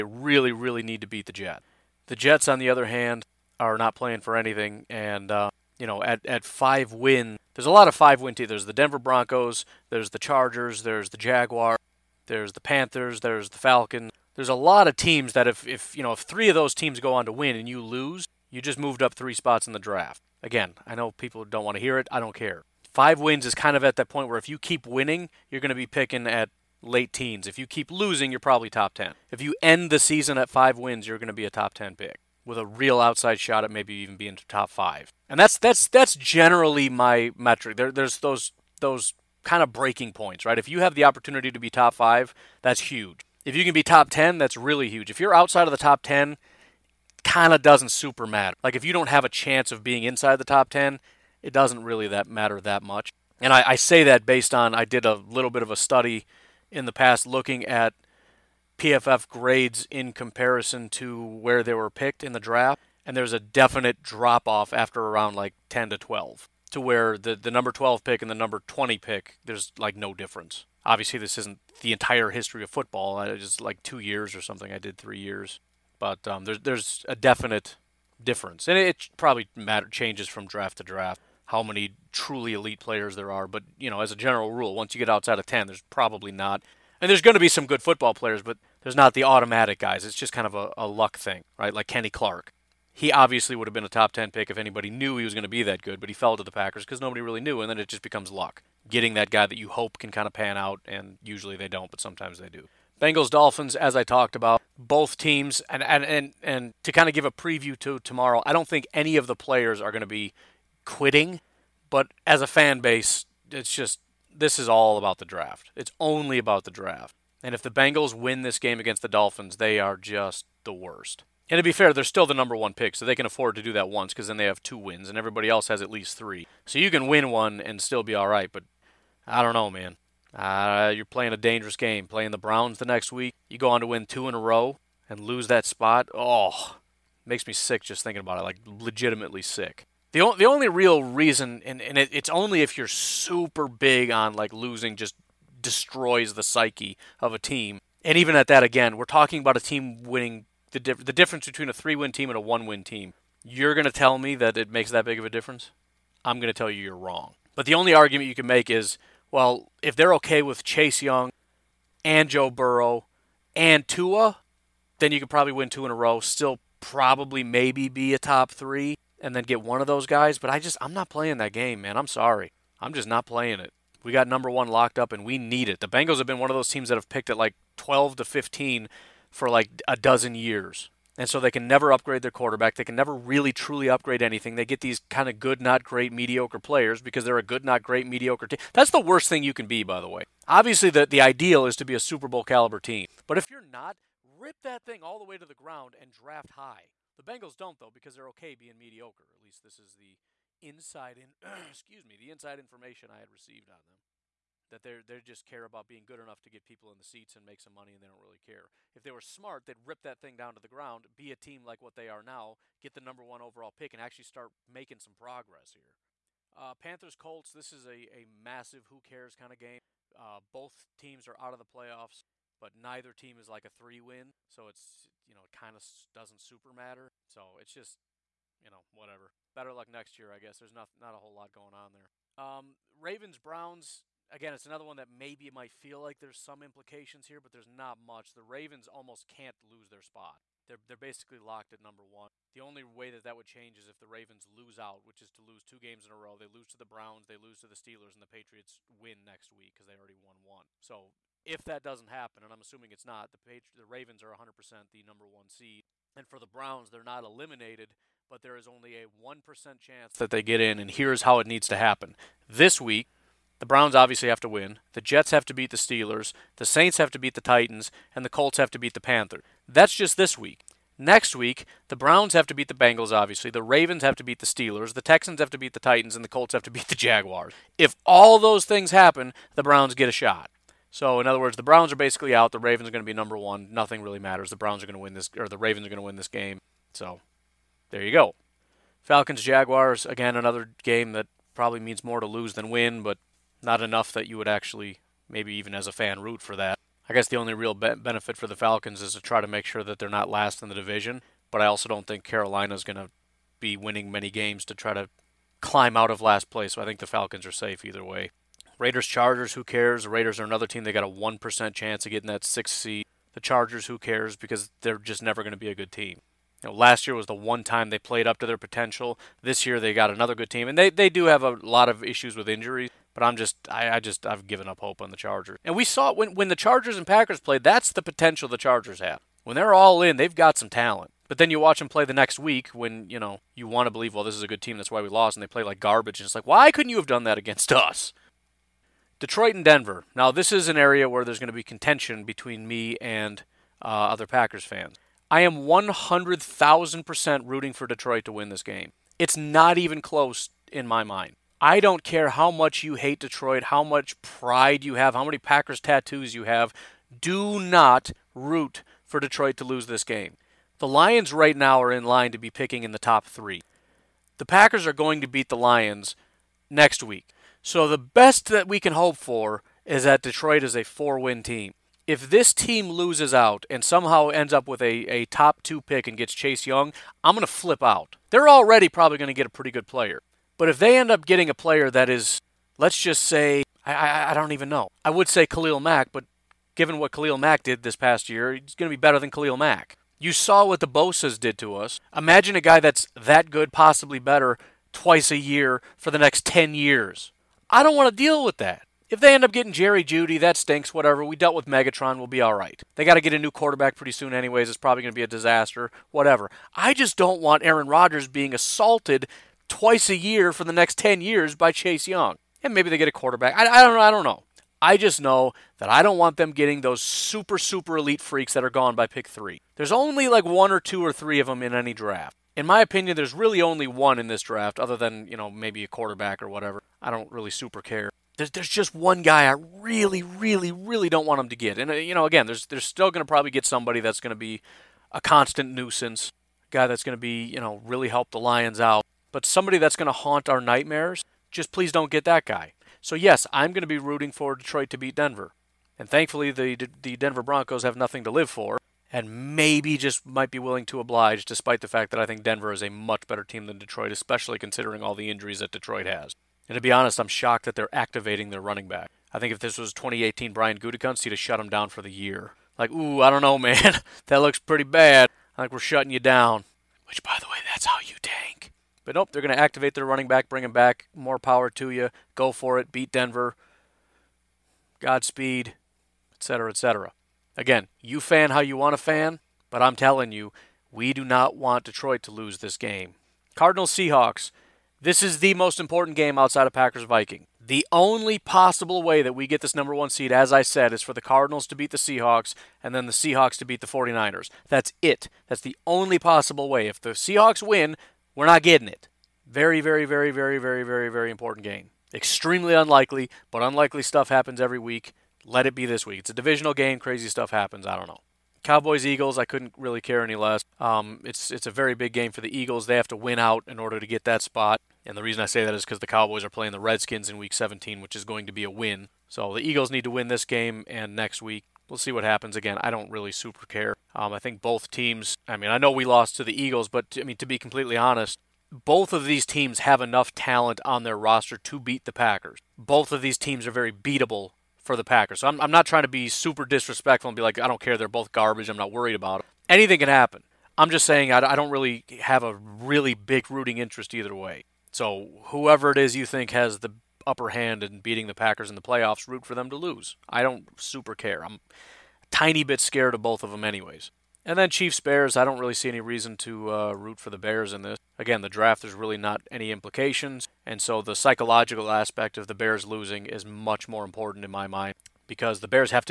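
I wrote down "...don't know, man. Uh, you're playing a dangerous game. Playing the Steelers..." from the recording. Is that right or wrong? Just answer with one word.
wrong.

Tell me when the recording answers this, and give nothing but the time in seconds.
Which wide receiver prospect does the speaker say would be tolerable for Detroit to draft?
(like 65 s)
399 s.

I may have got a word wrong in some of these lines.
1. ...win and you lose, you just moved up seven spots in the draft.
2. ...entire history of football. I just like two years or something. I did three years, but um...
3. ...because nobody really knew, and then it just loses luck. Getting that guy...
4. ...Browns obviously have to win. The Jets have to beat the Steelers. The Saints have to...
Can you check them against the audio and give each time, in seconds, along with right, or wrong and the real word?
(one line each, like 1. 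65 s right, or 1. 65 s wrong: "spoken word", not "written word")
1. 17 s wrong: "three", not "seven"
2. 71 s right
3. 96 s wrong: "becomes", not "loses"
4. 263 s right.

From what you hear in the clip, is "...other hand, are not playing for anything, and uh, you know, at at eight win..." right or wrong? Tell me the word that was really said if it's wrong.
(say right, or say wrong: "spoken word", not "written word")
wrong: "five", not "eight".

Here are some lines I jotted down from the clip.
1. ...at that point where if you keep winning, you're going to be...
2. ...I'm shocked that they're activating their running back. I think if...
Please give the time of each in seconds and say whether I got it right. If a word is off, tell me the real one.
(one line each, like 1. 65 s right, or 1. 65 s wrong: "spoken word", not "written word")
1. 23 s right
2. 457 s right.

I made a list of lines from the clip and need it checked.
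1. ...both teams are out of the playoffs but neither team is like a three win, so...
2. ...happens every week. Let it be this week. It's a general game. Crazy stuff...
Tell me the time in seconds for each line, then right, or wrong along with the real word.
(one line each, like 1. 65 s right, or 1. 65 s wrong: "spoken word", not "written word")
1. 220 s right
2. 504 s wrong: "divisional", not "general".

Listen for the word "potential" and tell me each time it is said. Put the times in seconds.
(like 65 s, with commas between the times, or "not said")
318 s, 328 s.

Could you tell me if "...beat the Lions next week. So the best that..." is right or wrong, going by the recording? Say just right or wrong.
right.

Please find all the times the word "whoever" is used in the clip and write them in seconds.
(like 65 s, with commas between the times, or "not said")
545 s.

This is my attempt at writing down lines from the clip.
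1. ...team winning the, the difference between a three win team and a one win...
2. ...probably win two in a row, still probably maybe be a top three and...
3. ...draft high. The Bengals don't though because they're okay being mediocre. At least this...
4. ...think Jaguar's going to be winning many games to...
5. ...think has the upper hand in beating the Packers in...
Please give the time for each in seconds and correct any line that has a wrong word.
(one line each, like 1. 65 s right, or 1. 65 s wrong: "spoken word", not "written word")
1. 149 s right
2. 165 s right
3. 196 s right
4. 302 s wrong: "Carolina", not "Jaguar"
5. 546 s right.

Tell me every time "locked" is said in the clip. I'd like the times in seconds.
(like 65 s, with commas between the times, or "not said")
174 s, 241 s.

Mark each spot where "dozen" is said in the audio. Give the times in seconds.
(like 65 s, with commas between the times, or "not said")
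179 s.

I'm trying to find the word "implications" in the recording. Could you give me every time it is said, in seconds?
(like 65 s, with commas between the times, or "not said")
236 s, 559 s.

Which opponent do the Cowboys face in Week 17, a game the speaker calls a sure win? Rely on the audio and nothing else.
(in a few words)
Redskins.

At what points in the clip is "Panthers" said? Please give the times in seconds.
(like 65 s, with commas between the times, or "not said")
12 s, 216 s, 268 s.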